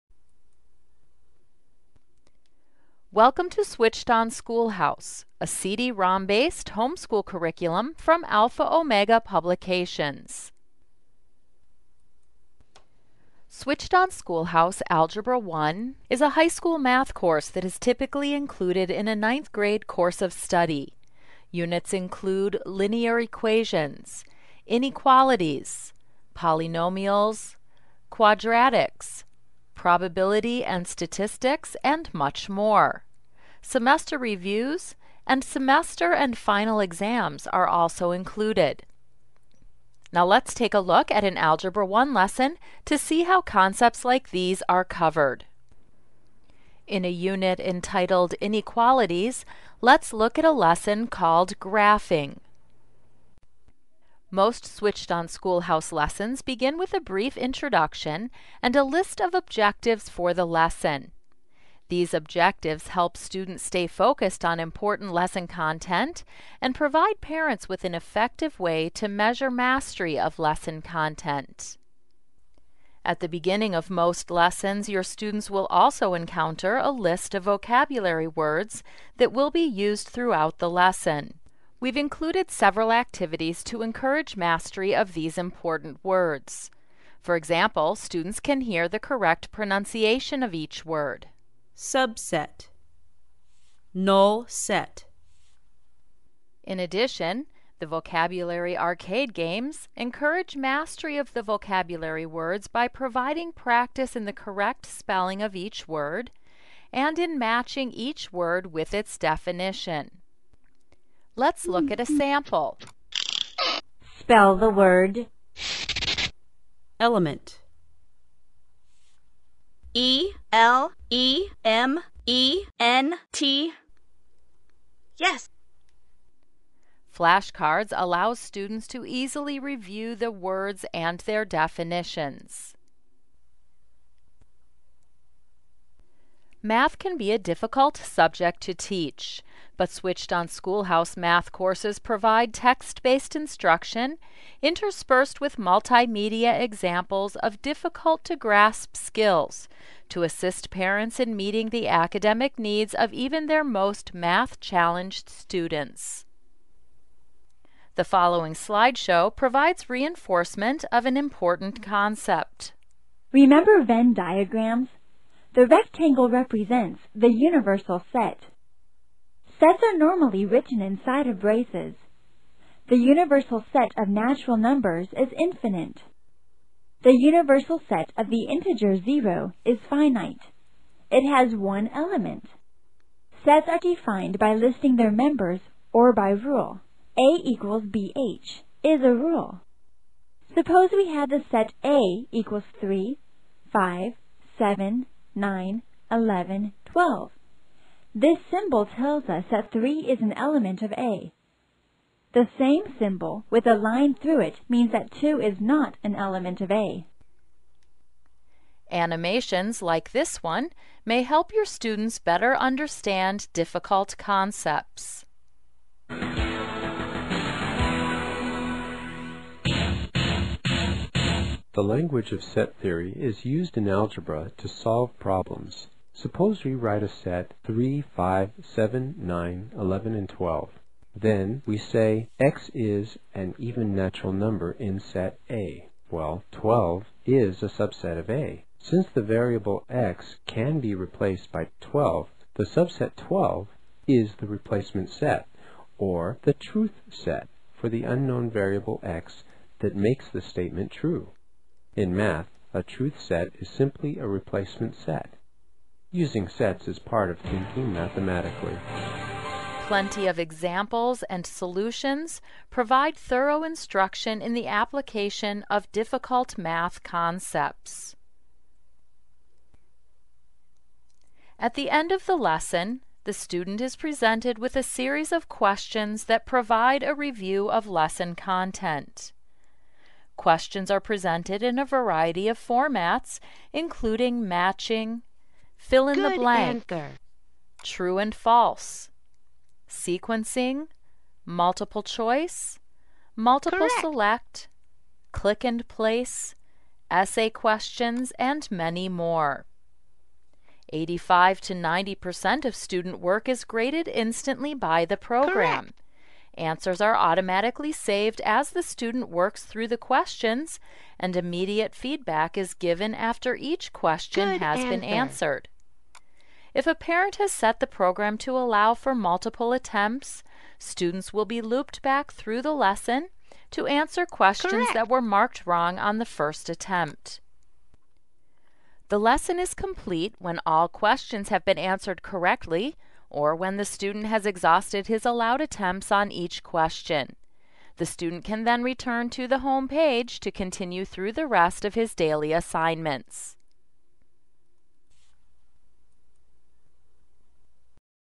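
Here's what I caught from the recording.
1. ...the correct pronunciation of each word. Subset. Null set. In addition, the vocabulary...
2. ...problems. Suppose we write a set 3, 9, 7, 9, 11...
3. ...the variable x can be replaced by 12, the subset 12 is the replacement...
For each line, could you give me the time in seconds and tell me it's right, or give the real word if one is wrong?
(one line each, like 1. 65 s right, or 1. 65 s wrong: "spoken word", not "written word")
1. 88 s right
2. 225 s wrong: "5", not "9"
3. 239 s right.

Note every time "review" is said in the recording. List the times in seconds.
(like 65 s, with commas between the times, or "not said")
34 s, 129 s, 277 s.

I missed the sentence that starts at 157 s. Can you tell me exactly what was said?
The following slideshow provides reinforcement of an important concept.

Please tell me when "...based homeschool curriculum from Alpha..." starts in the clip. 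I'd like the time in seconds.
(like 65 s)
6 s.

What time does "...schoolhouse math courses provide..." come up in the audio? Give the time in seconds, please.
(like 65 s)
140 s.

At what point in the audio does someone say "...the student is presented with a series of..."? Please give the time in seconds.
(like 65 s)
273 s.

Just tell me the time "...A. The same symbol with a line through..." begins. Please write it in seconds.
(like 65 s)
200 s.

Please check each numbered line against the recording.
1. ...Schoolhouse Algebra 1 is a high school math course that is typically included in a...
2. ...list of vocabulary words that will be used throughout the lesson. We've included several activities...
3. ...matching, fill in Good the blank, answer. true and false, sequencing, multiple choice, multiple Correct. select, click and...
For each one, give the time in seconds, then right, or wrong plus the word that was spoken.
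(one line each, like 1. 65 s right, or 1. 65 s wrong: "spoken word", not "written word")
1. 14 s right
2. 76 s right
3. 284 s right.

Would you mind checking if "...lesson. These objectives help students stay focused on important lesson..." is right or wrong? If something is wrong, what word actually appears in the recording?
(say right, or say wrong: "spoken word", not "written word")
right.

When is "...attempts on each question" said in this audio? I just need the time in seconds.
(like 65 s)
335 s.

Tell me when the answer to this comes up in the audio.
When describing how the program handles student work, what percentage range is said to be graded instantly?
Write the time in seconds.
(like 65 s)
300 s.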